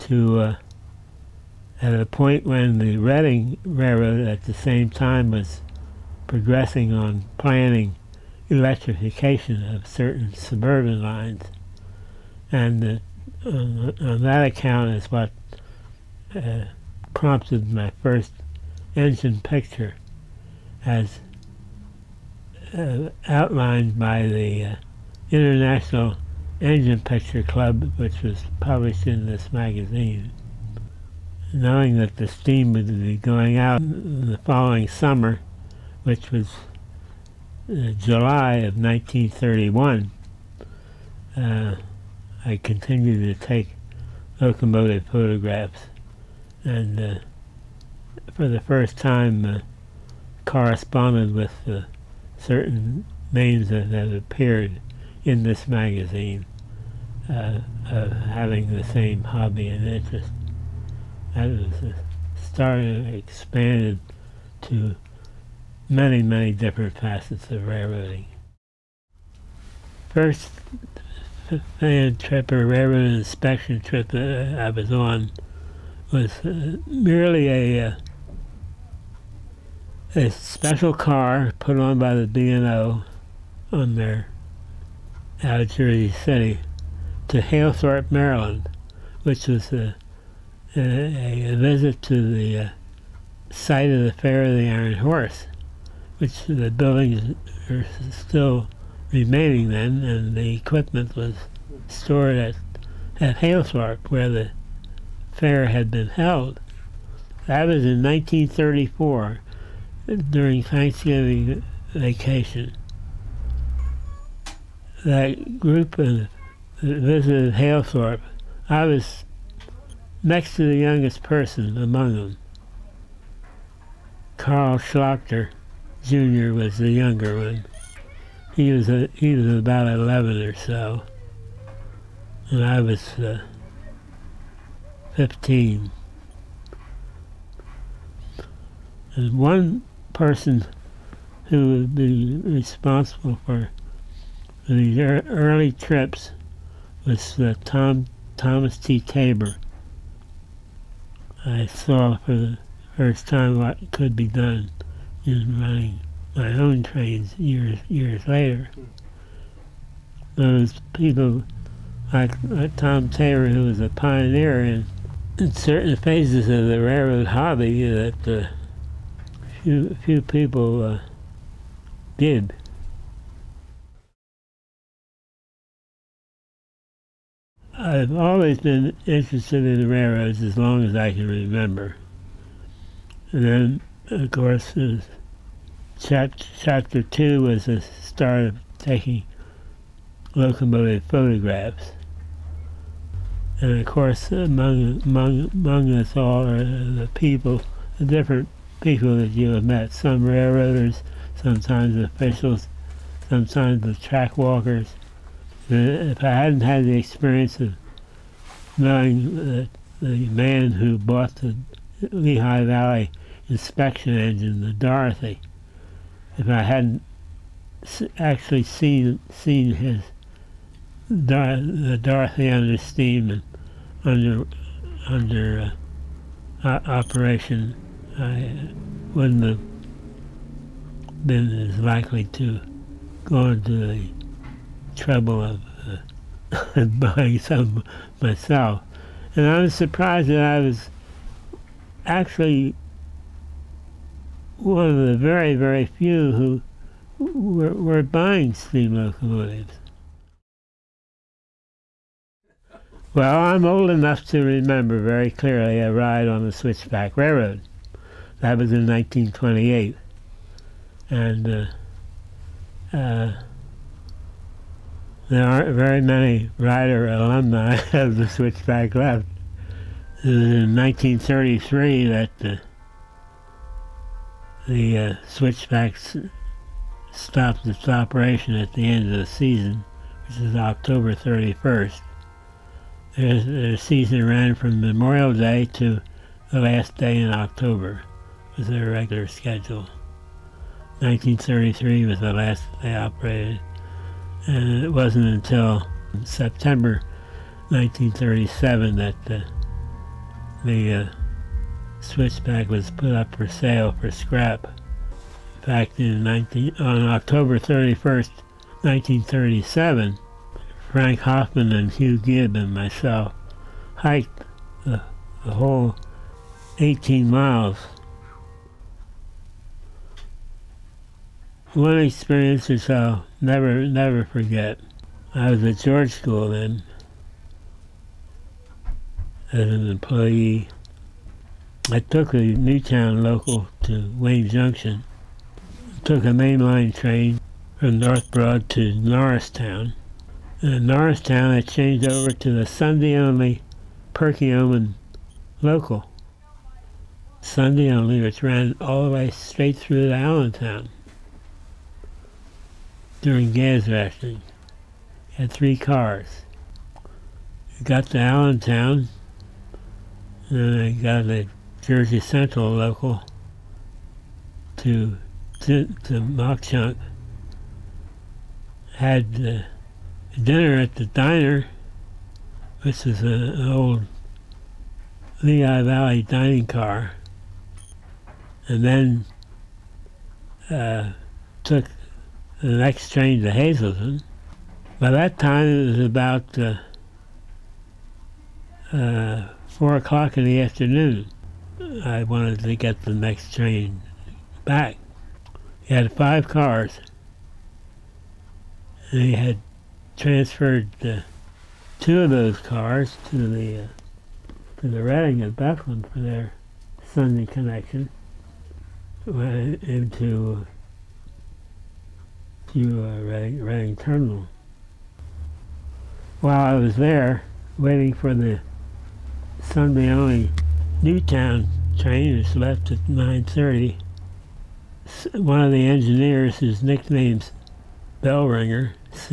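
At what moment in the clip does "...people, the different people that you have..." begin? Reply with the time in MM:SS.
03:17.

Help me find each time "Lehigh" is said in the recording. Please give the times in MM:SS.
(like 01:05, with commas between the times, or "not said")
03:32, 06:15.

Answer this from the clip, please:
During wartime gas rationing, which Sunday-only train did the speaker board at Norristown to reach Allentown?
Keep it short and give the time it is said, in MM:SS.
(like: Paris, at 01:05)
Perkiomen local, at 05:44.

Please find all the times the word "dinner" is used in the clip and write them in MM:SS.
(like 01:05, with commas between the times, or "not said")
06:10.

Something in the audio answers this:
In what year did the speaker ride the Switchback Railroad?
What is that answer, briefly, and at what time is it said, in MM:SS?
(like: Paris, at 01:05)
1928, at 04:18.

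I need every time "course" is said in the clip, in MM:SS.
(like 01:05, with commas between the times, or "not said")
03:04, 03:13.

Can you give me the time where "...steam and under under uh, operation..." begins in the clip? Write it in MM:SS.
03:42.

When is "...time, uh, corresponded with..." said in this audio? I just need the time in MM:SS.
00:48.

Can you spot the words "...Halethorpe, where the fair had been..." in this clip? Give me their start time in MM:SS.
01:43.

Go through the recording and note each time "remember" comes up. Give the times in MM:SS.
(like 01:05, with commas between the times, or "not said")
03:01, 04:14.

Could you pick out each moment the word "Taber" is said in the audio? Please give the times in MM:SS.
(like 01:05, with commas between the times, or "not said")
02:28, 02:43.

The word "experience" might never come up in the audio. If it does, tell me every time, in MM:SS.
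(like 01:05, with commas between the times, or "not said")
03:26, 05:21.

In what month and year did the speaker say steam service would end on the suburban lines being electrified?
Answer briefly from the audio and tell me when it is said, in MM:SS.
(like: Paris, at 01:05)
July 1931, at 00:37.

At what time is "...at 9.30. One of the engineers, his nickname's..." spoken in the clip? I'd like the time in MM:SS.
07:02.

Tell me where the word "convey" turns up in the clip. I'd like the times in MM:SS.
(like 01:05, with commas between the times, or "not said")
not said.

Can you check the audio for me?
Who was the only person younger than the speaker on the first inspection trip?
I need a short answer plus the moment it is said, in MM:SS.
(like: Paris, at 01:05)
Carl Schlochter Junior, at 02:04.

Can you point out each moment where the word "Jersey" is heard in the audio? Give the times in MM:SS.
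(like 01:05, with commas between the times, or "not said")
01:25, 06:01.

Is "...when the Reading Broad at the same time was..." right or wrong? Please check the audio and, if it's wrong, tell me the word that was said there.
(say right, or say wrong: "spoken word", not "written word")
wrong: "Railroad", not "Broad".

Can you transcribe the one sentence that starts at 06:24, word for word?
By that time, it was about uh, uh, 4 o'clock in the afternoon.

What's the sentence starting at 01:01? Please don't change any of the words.
That was the start expanded to many, many different facets of railroading.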